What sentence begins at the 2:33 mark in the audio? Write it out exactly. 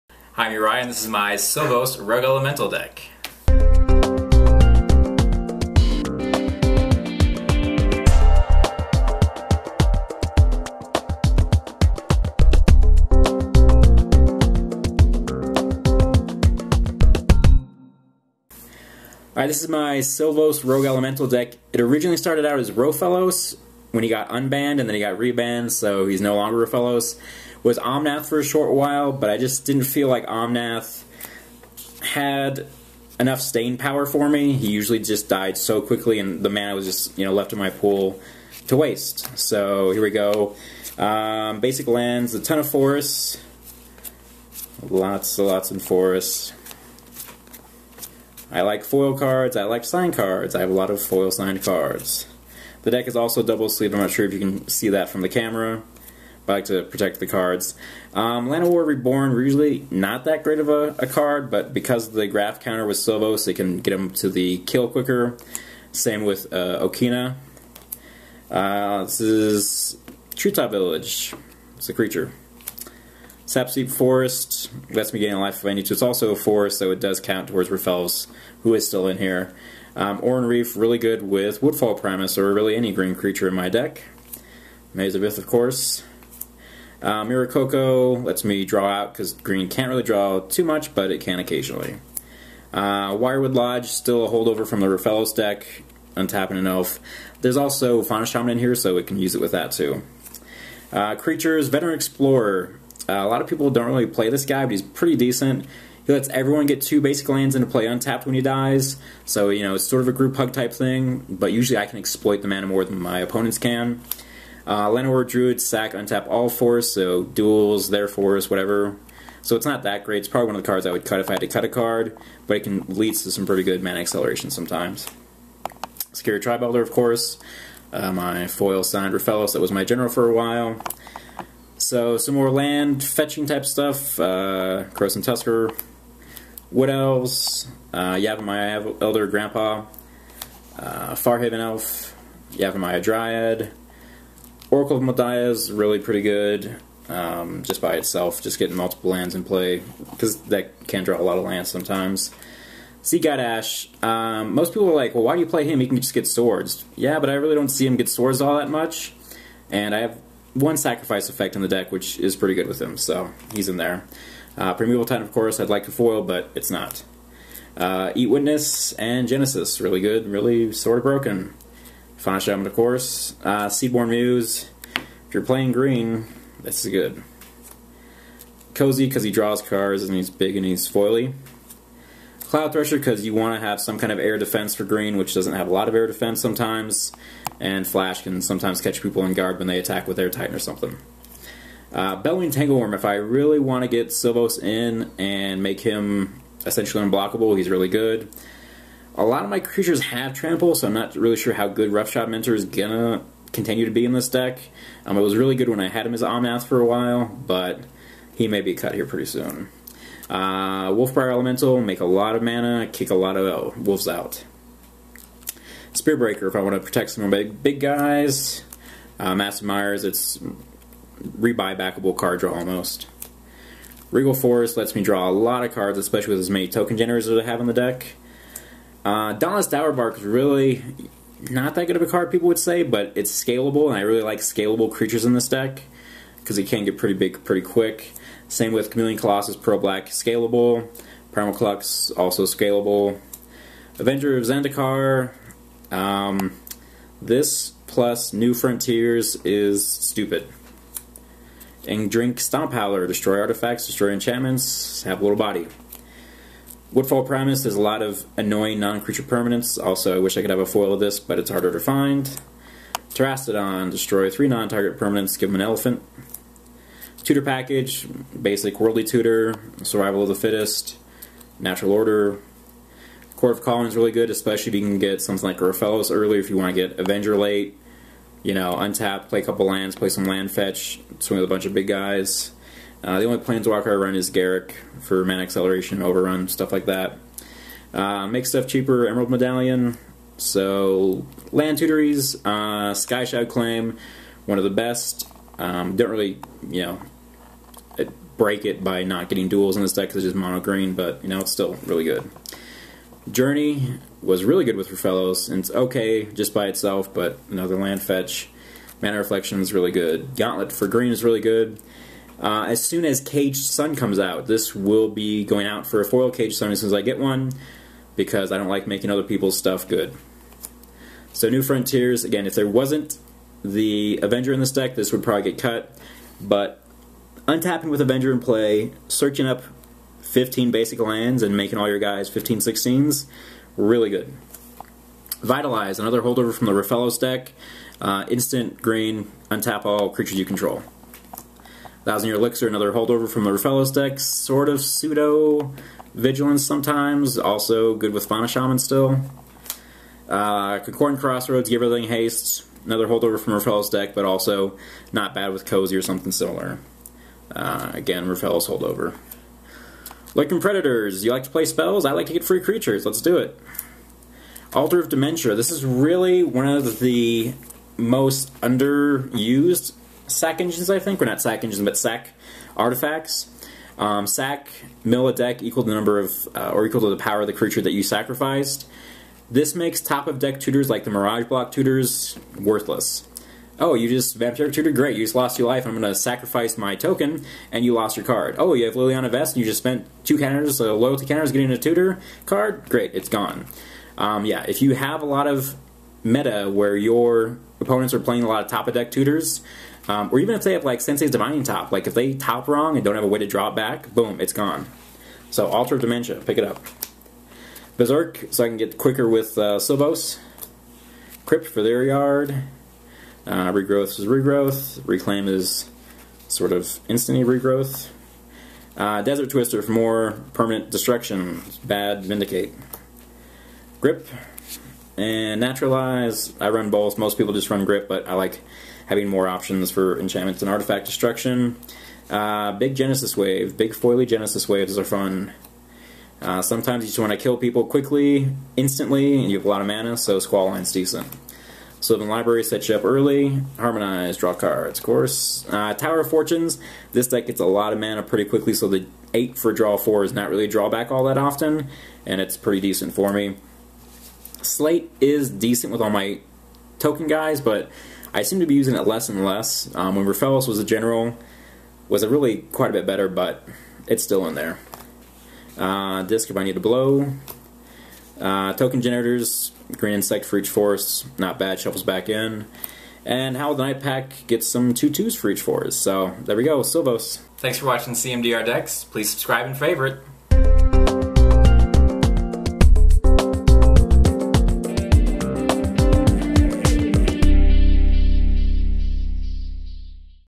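Seedguide Ash, um, most people are like, well, why do you play him?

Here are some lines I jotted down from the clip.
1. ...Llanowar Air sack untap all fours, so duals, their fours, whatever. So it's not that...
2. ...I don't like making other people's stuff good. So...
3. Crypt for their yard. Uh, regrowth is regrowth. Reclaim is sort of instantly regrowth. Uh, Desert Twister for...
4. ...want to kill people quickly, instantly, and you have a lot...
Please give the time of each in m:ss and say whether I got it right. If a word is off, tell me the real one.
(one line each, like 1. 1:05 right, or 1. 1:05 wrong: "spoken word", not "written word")
1. 1:54 wrong: "Druid", not "Air"
2. 5:18 right
3. 6:51 right
4. 7:17 right.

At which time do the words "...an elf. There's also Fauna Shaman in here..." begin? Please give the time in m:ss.
1:36.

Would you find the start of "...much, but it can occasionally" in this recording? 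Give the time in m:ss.
1:30.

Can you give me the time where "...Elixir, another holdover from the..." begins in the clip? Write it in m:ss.
5:42.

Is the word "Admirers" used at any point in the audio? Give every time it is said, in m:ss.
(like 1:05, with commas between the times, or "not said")
3:39.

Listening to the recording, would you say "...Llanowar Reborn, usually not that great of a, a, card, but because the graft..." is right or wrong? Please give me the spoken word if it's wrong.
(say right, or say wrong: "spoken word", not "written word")
right.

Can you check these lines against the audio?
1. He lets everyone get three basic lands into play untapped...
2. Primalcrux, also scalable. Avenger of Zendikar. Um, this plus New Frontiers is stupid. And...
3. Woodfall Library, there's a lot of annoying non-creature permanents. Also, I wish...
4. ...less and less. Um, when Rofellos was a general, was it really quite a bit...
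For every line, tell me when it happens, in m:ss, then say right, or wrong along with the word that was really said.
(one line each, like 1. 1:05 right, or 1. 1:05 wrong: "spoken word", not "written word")
1. 1:46 wrong: "two", not "three"
2. 4:01 right
3. 4:16 wrong: "Primus", not "Library"
4. 7:39 right.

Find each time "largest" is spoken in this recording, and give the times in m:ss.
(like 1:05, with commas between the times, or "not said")
not said.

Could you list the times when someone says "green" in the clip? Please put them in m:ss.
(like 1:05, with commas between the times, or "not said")
1:22, 1:29, 2:55, 3:04, 5:00, 5:10, 5:38, 7:49.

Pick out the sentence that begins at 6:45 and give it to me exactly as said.
So Altar of Dementia, pick it up.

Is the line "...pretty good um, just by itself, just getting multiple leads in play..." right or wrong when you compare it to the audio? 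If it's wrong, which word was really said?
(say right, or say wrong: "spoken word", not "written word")
wrong: "lands", not "leads".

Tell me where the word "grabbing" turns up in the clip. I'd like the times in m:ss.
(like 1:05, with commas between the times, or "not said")
not said.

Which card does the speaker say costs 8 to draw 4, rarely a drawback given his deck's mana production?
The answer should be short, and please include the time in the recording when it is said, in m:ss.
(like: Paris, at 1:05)
Tower of Fortunes, at 7:25.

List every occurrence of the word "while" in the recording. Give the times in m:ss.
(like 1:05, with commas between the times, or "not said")
0:28, 2:10, 3:26.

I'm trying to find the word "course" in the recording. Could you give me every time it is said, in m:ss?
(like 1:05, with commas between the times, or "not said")
1:25, 2:06, 2:45, 2:52, 7:25.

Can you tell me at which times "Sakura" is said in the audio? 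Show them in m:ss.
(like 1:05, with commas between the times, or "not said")
2:06.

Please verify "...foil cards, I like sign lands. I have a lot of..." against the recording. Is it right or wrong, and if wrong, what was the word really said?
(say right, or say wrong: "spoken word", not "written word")
wrong: "cards", not "lands".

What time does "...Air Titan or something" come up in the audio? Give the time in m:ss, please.
3:10.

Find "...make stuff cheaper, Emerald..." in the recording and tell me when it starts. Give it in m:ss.
4:48.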